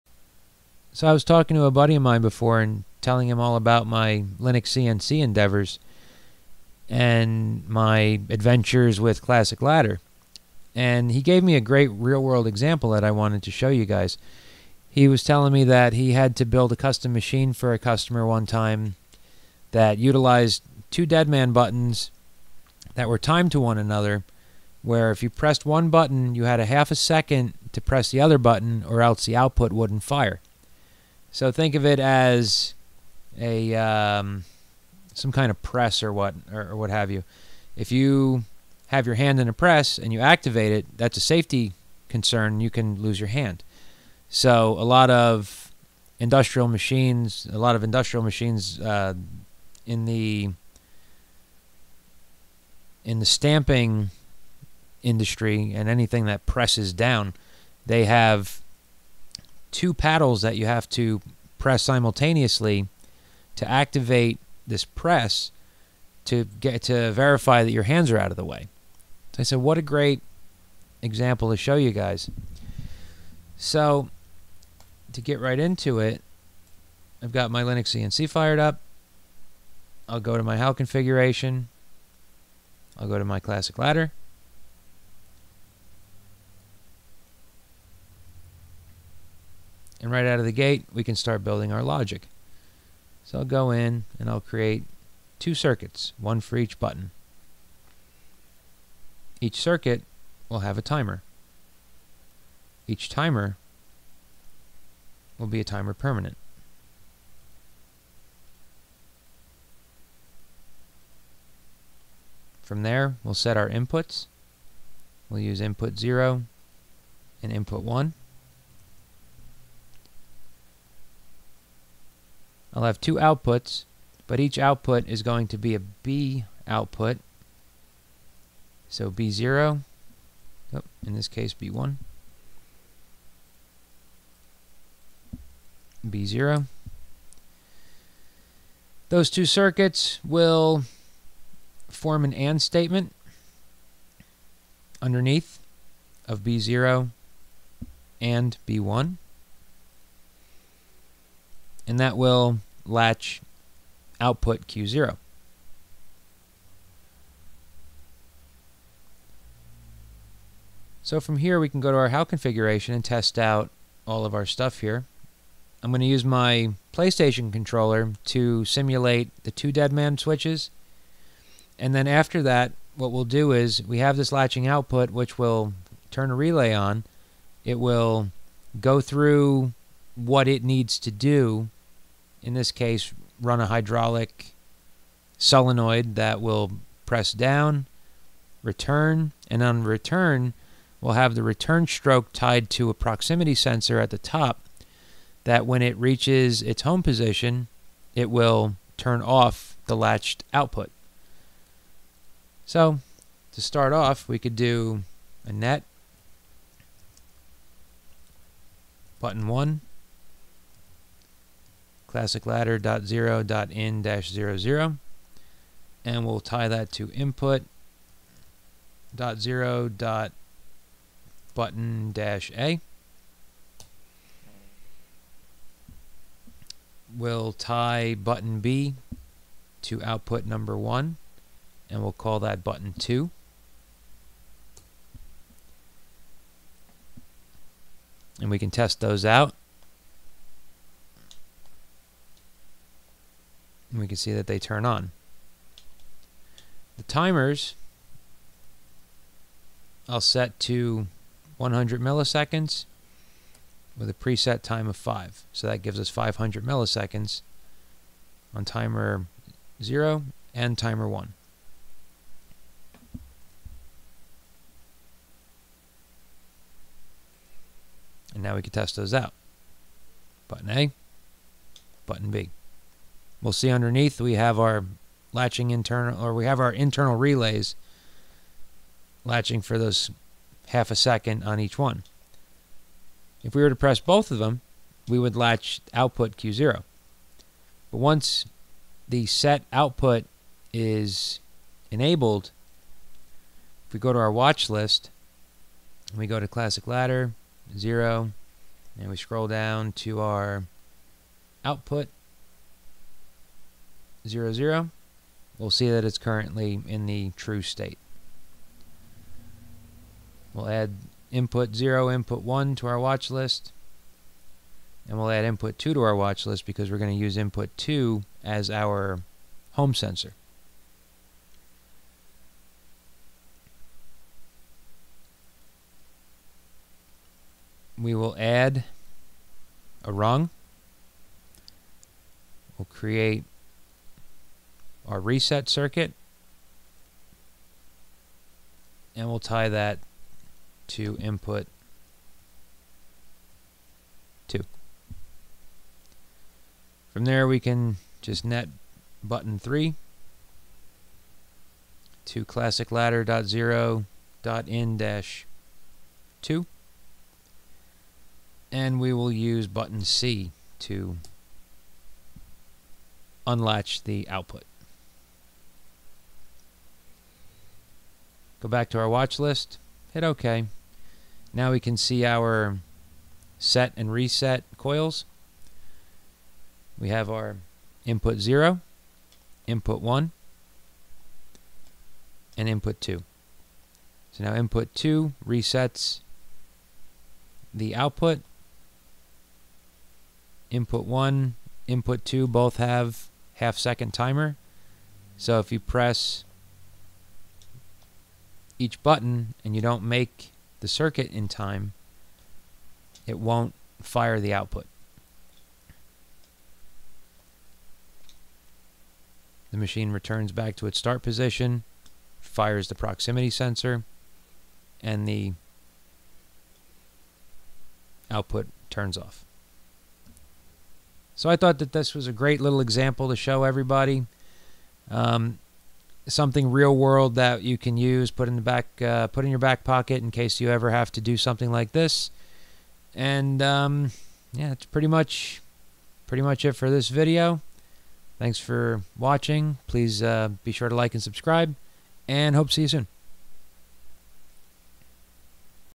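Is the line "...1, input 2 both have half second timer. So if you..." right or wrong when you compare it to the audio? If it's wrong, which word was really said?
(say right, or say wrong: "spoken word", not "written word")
right.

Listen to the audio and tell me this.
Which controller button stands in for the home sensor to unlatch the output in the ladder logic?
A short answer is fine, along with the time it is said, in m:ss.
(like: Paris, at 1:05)
button C, at 5:59.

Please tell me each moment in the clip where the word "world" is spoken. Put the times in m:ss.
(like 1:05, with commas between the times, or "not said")
0:12, 7:06.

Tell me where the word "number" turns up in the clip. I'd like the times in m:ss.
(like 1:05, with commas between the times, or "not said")
3:50.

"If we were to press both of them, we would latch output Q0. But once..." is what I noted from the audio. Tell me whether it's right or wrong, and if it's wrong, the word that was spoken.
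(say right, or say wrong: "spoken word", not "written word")
right.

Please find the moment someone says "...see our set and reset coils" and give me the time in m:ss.
6:11.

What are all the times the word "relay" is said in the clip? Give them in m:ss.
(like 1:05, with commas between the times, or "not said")
2:56, 4:37.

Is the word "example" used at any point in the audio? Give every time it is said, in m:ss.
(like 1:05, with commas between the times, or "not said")
0:12, 1:11, 7:02.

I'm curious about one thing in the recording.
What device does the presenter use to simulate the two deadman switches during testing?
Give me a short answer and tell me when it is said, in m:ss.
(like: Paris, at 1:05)
PlayStation controller, at 2:46.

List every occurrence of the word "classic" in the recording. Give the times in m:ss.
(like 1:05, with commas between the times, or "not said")
0:09, 1:23, 3:32, 4:56, 5:52.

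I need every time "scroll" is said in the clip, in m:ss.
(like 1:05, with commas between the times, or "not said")
4:59.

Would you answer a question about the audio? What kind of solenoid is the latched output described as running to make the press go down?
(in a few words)
hydraulic solenoid.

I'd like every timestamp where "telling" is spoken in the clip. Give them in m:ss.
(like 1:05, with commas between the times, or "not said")
0:02, 0:15.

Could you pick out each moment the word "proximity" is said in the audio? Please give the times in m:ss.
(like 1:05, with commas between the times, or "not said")
3:12, 6:52.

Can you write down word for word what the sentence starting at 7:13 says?
And um, yeah, that's pretty much pretty much it for this video.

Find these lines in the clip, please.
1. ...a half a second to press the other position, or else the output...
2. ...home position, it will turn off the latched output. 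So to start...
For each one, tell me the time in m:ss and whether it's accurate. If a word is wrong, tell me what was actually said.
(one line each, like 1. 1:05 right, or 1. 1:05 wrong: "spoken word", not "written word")
1. 0:26 wrong: "button", not "position"
2. 3:16 right.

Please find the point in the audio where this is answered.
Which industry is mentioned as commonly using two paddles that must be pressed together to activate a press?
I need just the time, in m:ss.
0:53.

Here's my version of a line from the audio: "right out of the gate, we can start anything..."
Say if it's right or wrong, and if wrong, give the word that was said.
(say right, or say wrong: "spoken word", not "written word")
wrong: "building", not "anything".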